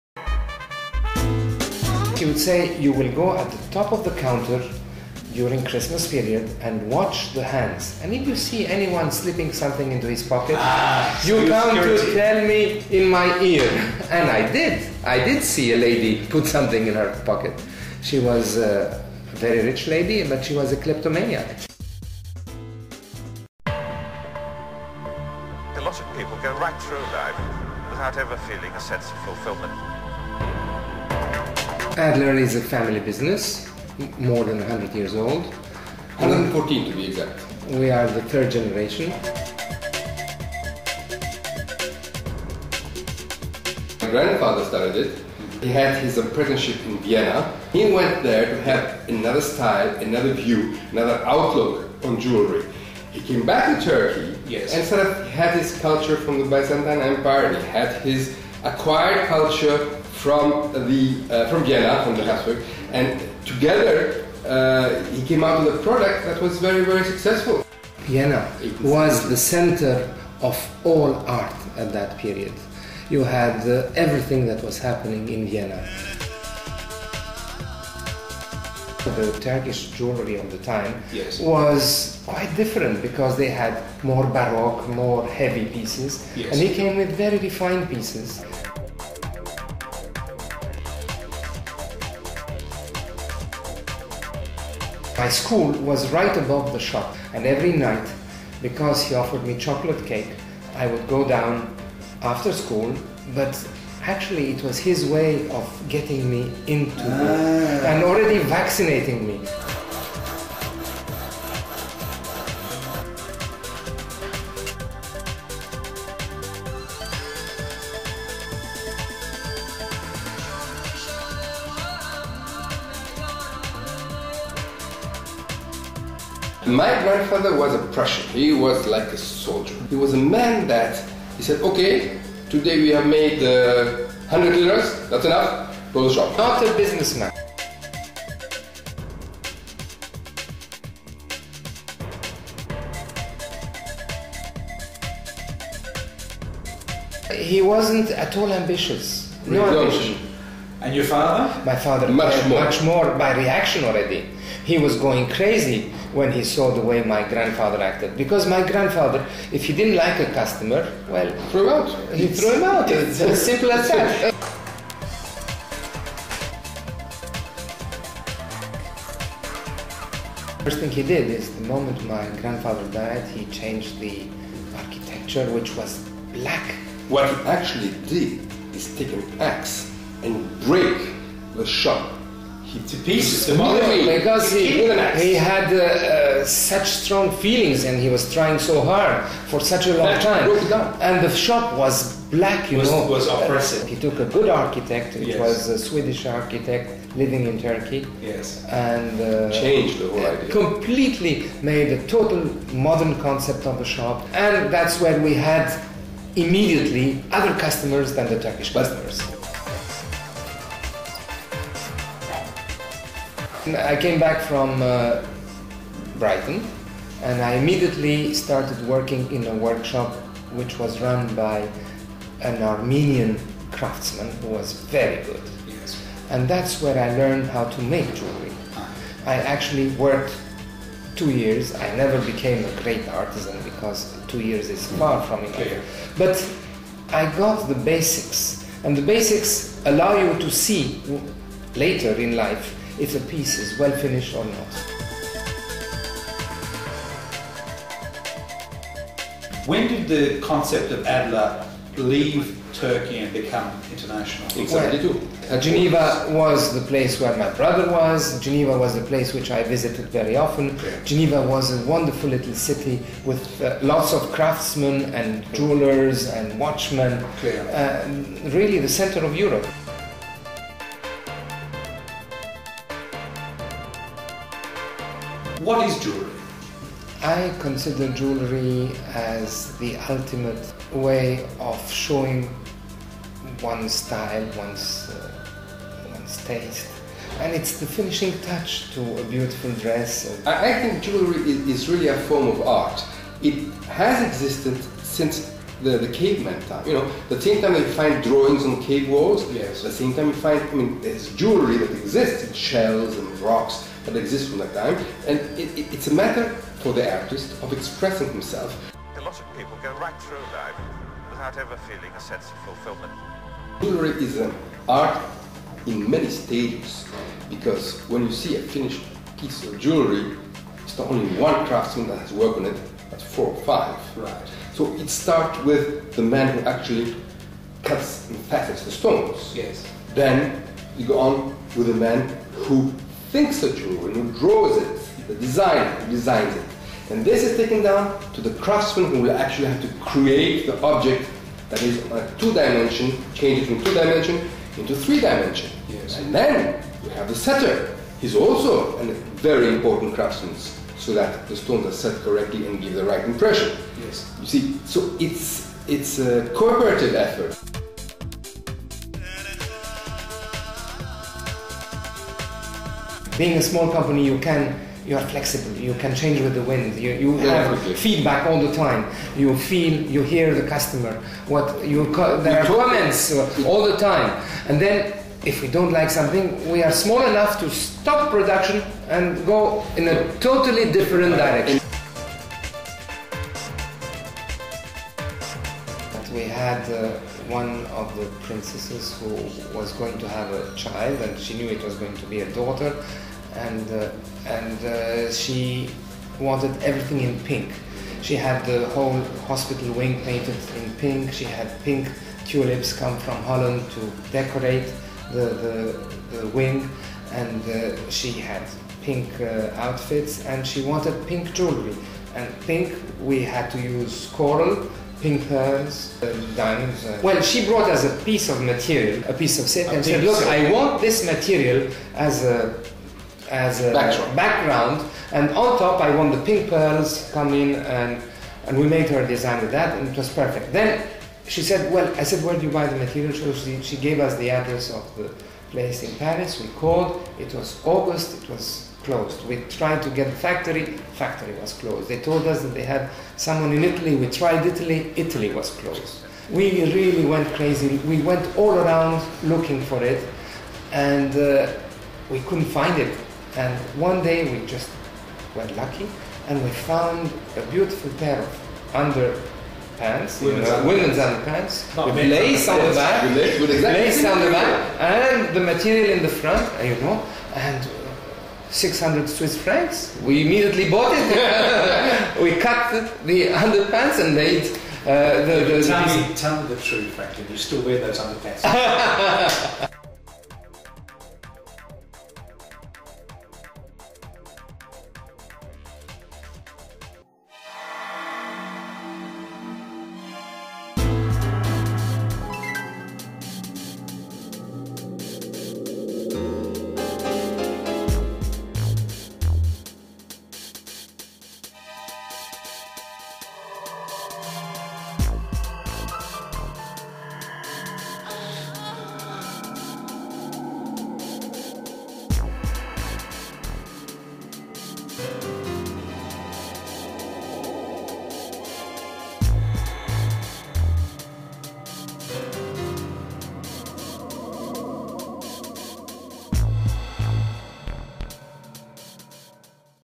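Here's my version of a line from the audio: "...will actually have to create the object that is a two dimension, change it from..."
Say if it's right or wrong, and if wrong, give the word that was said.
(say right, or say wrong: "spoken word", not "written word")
right.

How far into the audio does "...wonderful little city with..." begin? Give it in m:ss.
4:21.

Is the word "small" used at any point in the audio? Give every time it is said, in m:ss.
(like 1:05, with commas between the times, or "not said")
6:03, 6:16.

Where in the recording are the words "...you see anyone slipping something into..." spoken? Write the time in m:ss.
0:08.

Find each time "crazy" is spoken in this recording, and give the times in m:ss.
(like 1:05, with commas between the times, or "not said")
2:35, 7:27.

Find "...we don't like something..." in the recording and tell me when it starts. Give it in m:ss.
6:15.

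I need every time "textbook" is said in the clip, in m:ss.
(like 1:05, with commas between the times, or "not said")
not said.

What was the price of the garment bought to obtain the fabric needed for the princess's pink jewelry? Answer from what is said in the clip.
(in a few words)
600 Swiss francs.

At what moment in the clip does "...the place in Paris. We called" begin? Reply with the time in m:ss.
7:15.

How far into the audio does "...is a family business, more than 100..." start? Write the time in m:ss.
0:32.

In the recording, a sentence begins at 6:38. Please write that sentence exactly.
She had the whole hospital wing painted in pink.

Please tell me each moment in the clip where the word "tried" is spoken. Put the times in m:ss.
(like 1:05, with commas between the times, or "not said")
7:19, 7:24.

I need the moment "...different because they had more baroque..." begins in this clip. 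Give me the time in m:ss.
1:22.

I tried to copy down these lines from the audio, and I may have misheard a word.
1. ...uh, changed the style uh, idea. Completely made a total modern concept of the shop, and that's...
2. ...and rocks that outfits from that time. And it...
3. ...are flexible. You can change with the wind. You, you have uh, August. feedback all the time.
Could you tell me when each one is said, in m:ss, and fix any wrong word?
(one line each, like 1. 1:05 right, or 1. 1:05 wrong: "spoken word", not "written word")
1. 3:19 wrong: "whole", not "style"
2. 5:03 wrong: "exists", not "outfits"
3. 6:05 wrong: "Everything", not "August".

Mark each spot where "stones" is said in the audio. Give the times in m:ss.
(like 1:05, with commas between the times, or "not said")
5:28, 5:51.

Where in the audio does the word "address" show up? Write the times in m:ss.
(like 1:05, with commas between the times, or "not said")
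7:14.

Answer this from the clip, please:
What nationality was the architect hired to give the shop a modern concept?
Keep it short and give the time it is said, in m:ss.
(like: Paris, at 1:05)
Swedish, at 3:15.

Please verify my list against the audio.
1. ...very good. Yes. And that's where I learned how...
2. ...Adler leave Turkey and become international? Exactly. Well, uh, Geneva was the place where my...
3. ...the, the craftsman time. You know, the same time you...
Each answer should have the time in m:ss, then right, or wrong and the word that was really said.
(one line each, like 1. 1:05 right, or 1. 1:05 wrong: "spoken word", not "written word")
1. 3:44 right
2. 4:11 right
3. 4:55 wrong: "caveman", not "craftsman".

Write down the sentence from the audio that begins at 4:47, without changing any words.
And it's the finishing touch to a beautiful dress.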